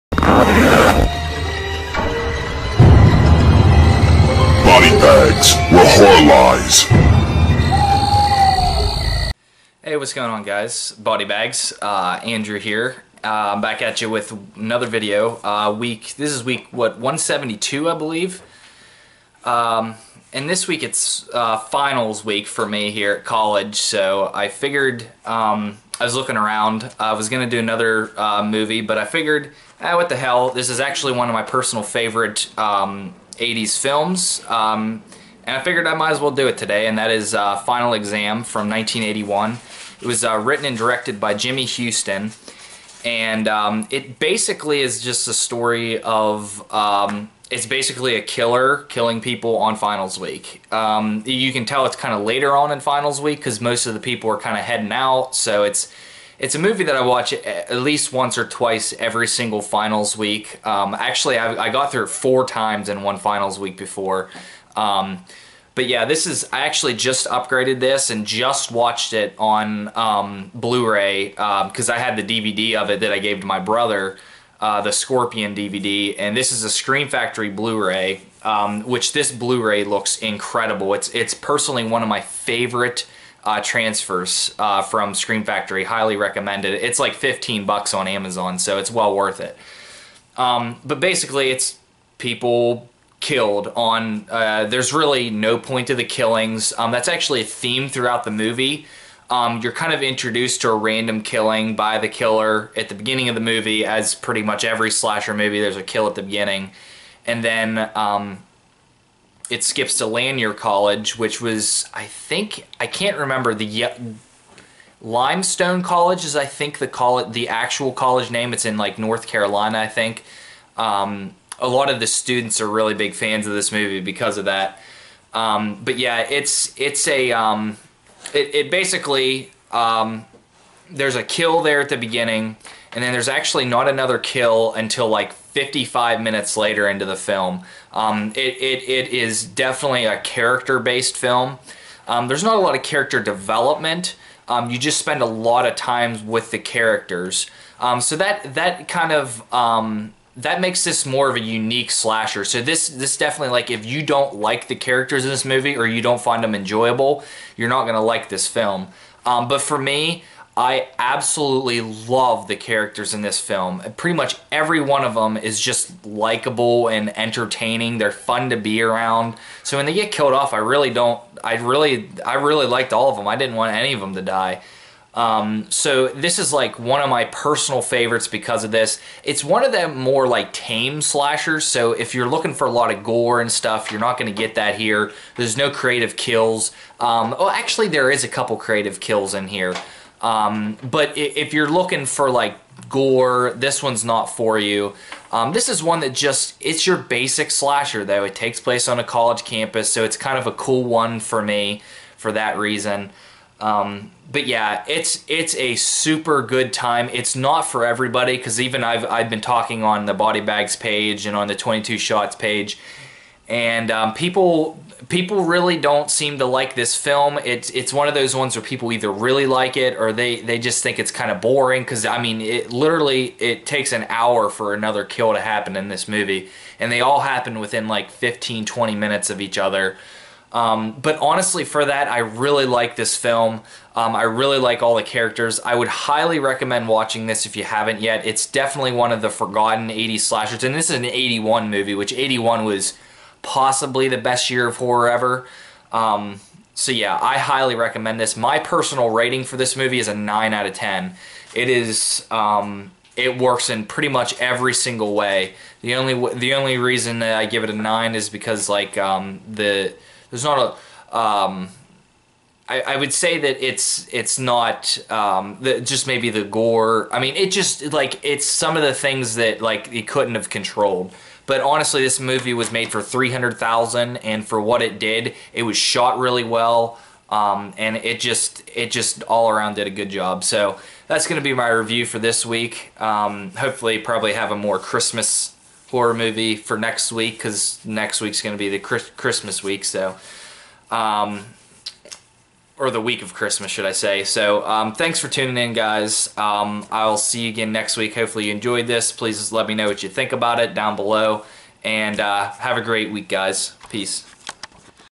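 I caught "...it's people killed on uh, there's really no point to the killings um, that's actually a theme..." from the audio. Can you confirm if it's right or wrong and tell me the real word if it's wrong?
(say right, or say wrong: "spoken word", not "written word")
right.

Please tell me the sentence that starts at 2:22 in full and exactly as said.
Um, there's not a lot of character development.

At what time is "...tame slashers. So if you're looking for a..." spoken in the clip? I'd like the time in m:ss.
3:00.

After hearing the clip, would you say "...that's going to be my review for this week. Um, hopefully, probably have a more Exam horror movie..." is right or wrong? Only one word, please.
wrong.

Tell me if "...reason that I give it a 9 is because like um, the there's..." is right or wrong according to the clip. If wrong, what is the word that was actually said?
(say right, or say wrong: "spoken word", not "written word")
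right.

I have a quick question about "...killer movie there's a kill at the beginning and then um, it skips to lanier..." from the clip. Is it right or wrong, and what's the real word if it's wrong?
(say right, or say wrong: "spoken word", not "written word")
wrong: "slasher", not "killer".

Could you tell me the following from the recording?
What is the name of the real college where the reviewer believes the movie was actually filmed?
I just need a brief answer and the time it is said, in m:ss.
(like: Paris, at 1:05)
Limestone College, at 1:54.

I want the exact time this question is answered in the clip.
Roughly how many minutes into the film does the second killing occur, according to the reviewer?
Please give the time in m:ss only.
2:15.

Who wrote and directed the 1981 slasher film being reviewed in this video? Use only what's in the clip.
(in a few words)
Jimmy Huston.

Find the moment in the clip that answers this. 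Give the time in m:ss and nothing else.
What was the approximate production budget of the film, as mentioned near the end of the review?
4:33.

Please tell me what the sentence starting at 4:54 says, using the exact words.
So, um, thanks for tuning in, guys.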